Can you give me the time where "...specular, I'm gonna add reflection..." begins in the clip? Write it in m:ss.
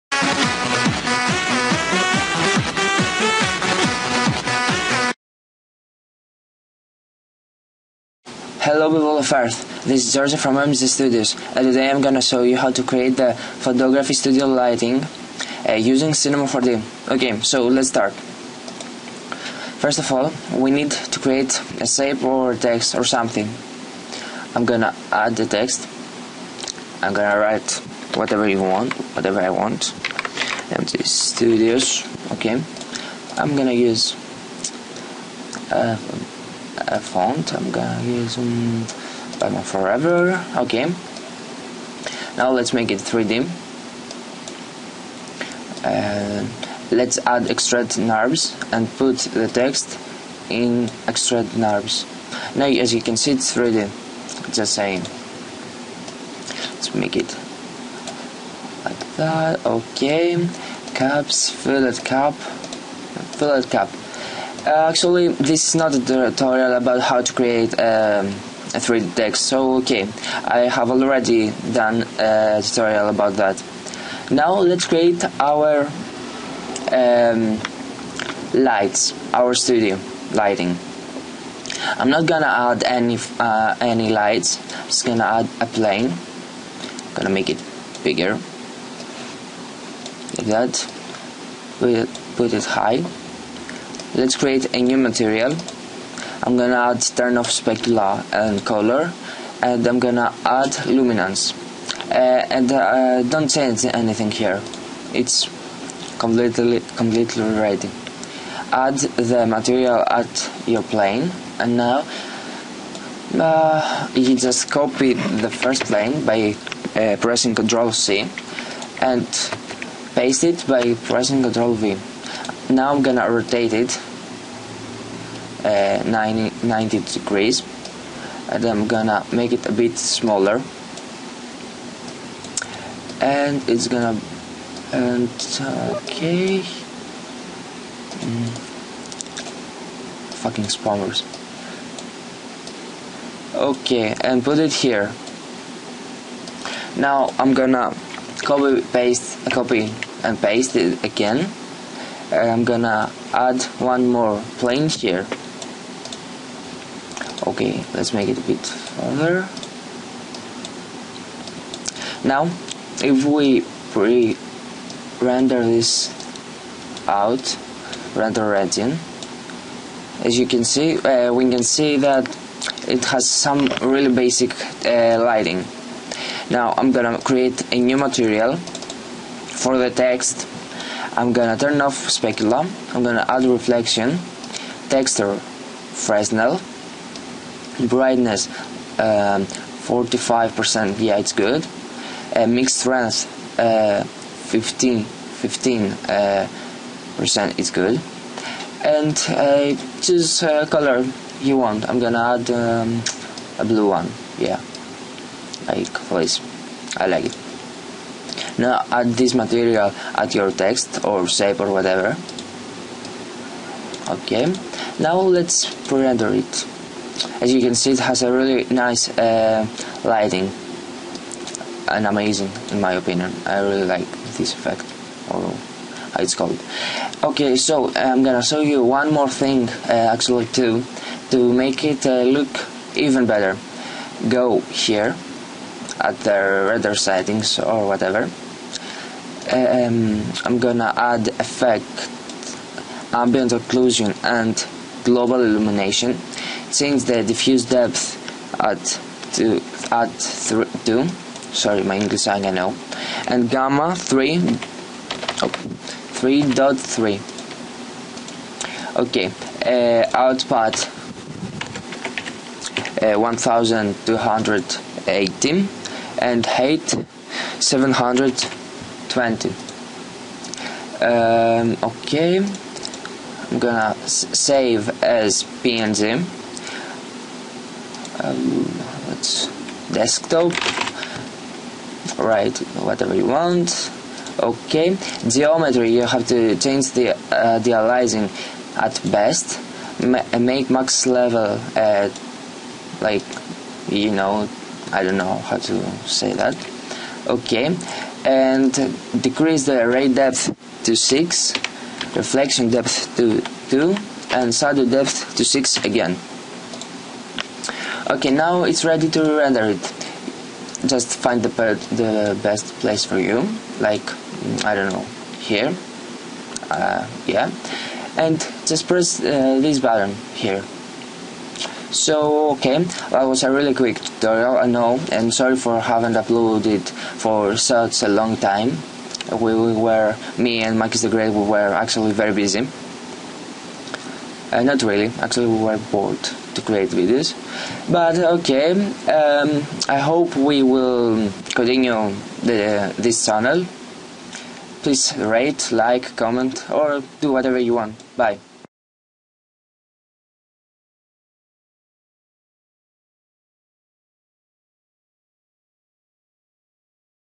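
3:02.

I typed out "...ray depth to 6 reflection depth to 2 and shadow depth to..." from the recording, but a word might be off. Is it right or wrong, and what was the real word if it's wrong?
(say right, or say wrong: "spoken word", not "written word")
right.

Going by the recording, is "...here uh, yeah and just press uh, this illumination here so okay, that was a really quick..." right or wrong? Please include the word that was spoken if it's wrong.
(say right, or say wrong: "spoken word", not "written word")
wrong: "button", not "illumination".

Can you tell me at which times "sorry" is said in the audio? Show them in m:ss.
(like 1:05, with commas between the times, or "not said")
4:11, 5:25.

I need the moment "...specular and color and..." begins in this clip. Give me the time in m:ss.
1:37.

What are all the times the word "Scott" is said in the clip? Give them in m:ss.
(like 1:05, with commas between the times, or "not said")
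not said.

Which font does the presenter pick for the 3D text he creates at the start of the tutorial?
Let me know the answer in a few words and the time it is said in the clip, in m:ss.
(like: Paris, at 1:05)
Batman Forever, at 0:39.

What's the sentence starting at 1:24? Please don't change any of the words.
I'm just gonna add a plane.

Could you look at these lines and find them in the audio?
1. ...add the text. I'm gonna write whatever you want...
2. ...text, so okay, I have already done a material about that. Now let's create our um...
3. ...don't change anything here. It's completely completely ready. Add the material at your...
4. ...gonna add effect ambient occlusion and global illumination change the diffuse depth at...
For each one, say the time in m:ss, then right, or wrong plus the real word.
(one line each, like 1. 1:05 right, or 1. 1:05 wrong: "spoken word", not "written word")
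1. 0:25 right
2. 1:09 wrong: "tutorial", not "material"
3. 1:43 right
4. 4:00 right.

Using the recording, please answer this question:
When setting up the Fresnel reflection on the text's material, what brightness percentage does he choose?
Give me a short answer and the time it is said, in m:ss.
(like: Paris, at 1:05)
45%, at 3:09.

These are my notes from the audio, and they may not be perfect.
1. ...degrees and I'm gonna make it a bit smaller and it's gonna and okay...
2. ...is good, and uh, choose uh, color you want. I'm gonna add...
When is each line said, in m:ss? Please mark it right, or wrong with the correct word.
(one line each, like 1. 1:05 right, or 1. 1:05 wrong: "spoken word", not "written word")
1. 2:07 right
2. 3:17 right.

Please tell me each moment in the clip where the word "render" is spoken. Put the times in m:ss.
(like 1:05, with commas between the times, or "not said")
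2:43, 2:48, 3:35, 3:56, 5:09.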